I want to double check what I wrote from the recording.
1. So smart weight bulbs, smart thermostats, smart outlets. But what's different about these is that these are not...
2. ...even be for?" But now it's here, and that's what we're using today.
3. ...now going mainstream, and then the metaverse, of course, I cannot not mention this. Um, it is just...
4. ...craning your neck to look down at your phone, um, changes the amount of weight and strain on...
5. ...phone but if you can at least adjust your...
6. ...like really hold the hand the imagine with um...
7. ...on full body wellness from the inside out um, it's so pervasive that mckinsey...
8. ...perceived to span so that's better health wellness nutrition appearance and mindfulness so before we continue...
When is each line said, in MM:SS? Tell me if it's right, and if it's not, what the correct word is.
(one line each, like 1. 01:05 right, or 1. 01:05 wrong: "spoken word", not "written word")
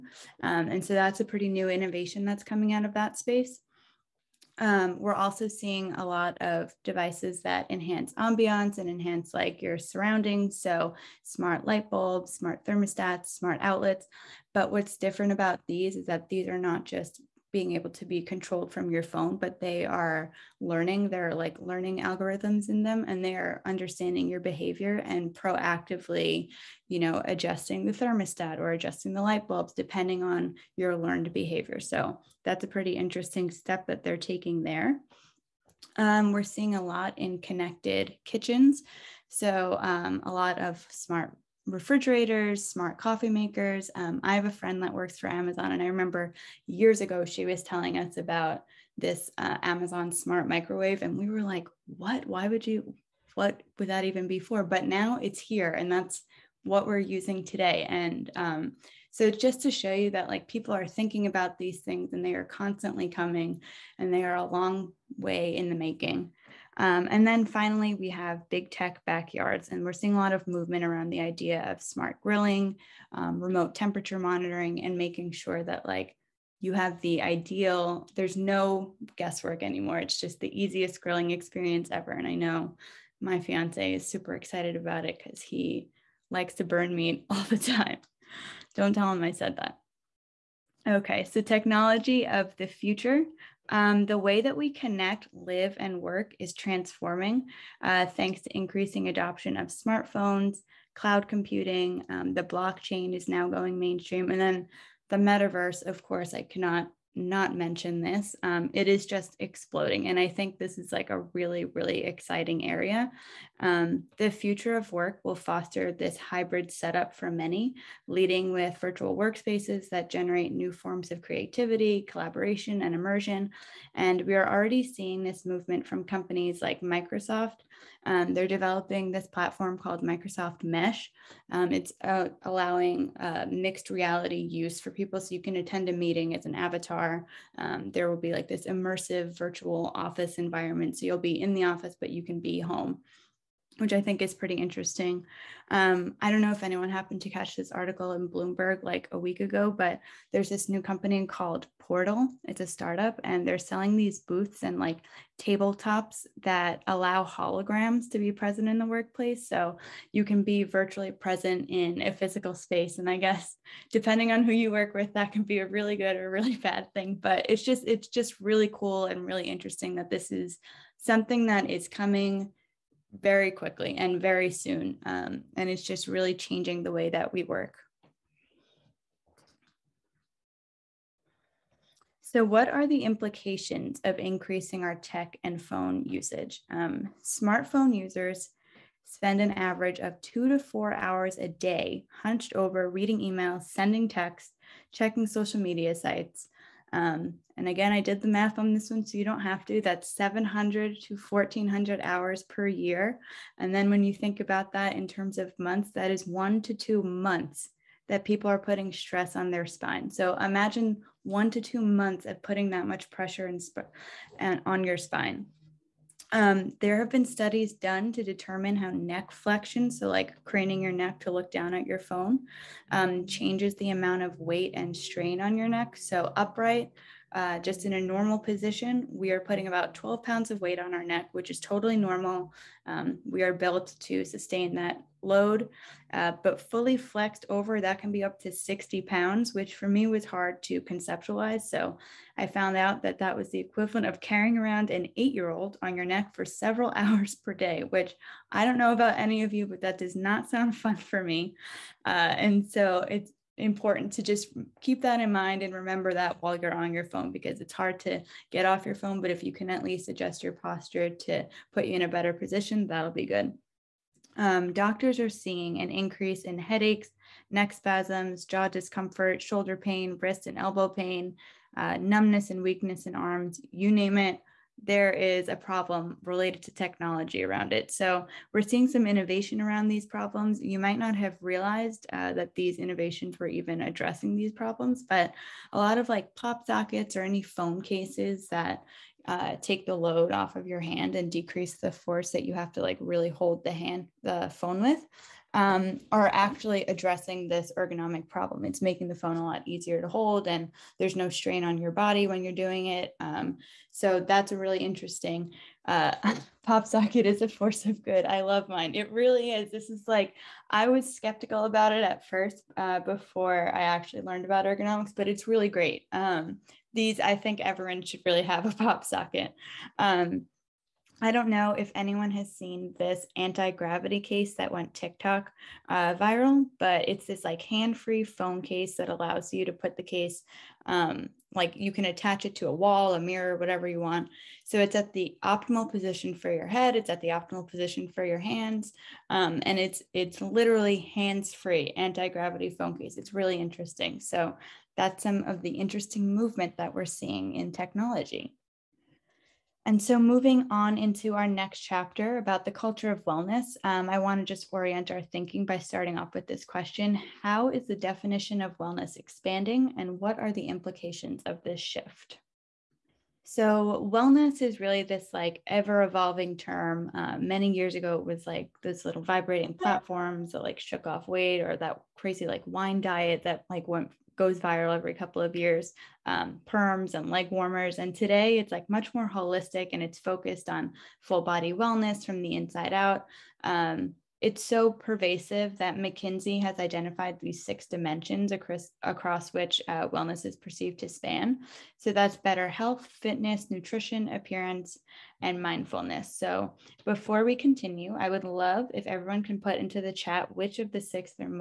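1. 00:10 wrong: "light", not "weight"
2. 00:54 right
3. 01:43 right
4. 03:40 right
5. 04:18 right
6. 04:52 wrong: "phone", not "imagine"
7. 06:20 right
8. 06:30 wrong: "fitness", not "wellness".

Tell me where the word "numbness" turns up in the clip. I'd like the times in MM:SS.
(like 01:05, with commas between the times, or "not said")
04:31.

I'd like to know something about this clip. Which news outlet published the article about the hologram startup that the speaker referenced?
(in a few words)
Bloomberg.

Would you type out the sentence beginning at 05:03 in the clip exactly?
Um, so that's a really interesting.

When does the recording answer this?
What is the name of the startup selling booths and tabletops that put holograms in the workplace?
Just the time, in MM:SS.
02:31.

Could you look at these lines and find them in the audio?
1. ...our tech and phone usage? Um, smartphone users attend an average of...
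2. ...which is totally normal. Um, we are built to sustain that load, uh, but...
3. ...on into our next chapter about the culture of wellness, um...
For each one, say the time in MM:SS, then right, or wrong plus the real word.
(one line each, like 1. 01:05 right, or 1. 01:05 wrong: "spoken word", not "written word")
1. 03:04 wrong: "spend", not "attend"
2. 03:51 right
3. 05:50 right.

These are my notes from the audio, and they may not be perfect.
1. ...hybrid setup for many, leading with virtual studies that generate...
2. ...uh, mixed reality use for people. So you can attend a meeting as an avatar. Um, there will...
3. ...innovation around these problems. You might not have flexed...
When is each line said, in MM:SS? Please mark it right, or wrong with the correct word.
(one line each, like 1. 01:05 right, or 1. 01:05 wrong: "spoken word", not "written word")
1. 01:56 wrong: "workspaces", not "studies"
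2. 02:13 right
3. 04:39 wrong: "realized", not "flexed".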